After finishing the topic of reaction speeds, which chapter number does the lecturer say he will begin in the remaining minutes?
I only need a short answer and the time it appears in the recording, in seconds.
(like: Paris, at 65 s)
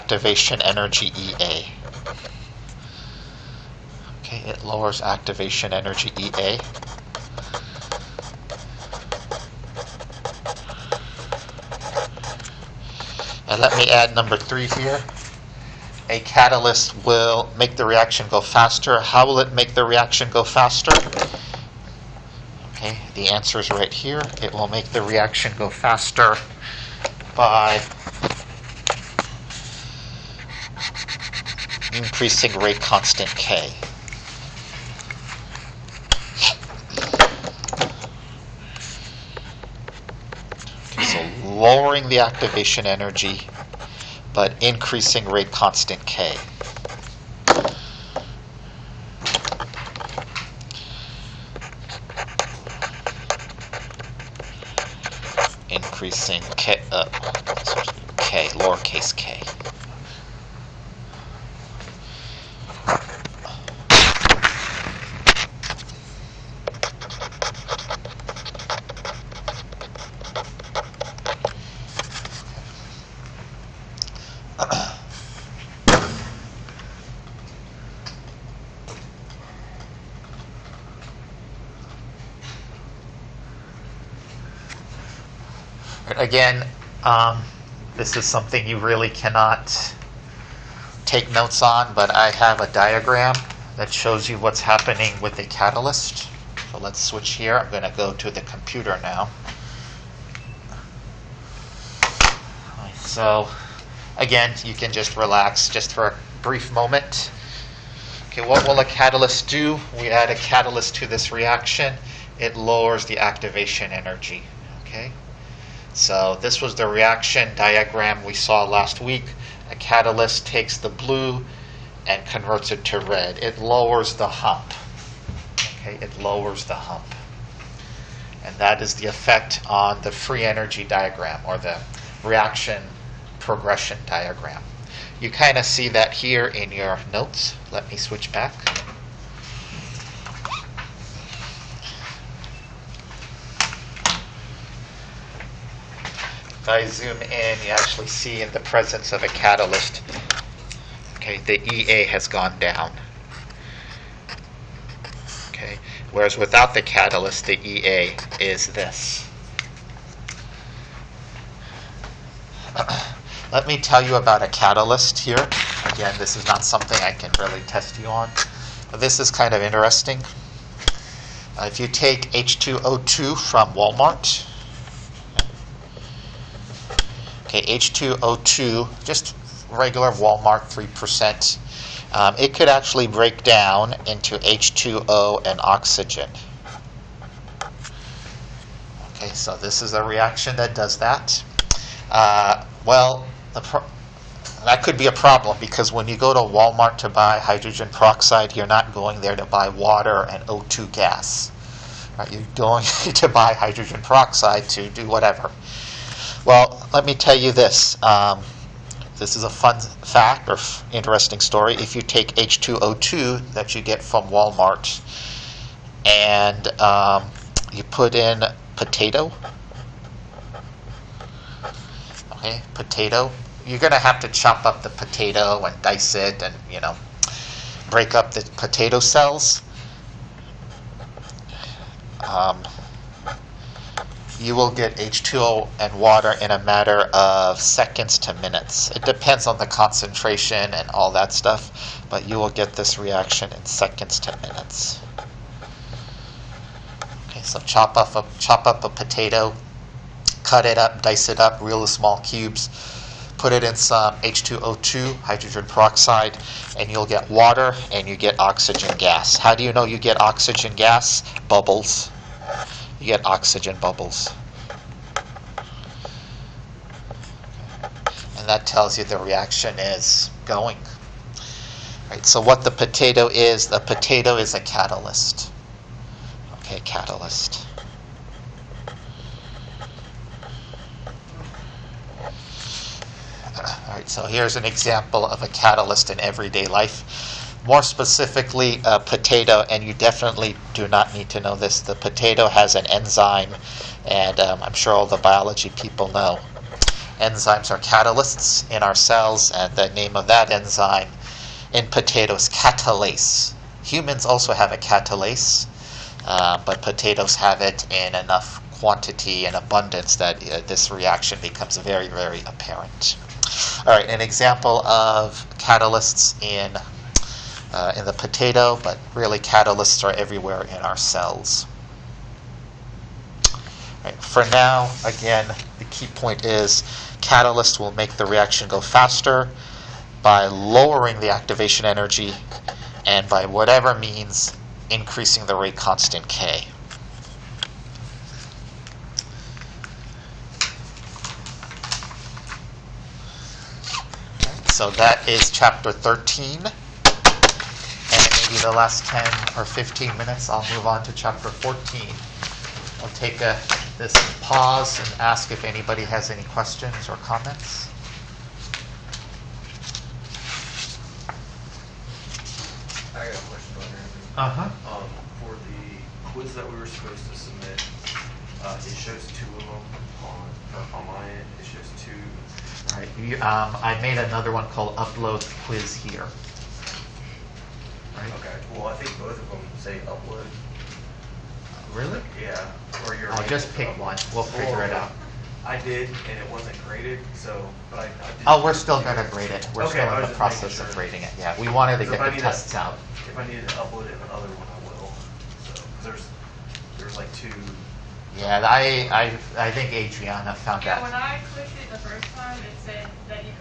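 14, at 351 s.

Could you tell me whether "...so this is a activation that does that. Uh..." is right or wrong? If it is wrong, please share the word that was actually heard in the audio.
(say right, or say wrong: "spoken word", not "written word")
wrong: "reaction", not "activation".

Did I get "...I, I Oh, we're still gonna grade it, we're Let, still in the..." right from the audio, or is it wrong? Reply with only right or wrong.
wrong.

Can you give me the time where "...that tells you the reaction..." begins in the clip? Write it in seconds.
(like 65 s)
268 s.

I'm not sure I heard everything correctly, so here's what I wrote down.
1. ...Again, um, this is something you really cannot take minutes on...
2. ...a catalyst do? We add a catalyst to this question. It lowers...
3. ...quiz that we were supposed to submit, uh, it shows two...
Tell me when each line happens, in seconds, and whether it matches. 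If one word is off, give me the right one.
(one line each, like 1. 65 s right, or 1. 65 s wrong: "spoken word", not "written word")
1. 86 s wrong: "notes", not "minutes"
2. 108 s wrong: "reaction", not "question"
3. 366 s right.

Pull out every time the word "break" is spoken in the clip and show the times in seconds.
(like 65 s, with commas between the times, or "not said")
183 s, 227 s.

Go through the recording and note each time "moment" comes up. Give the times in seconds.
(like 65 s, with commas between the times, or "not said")
106 s.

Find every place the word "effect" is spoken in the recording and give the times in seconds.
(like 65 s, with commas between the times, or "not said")
129 s.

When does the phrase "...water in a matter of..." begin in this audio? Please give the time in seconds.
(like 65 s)
235 s.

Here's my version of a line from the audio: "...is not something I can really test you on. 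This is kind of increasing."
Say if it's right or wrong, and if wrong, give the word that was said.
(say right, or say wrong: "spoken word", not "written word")
wrong: "interesting", not "increasing".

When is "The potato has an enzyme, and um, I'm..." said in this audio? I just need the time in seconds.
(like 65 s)
291 s.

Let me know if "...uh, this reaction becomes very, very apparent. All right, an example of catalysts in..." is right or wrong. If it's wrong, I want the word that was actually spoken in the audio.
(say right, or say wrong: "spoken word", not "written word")
right.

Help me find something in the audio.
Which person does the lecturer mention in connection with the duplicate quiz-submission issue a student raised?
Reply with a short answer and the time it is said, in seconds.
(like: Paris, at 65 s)
Adriana, at 399 s.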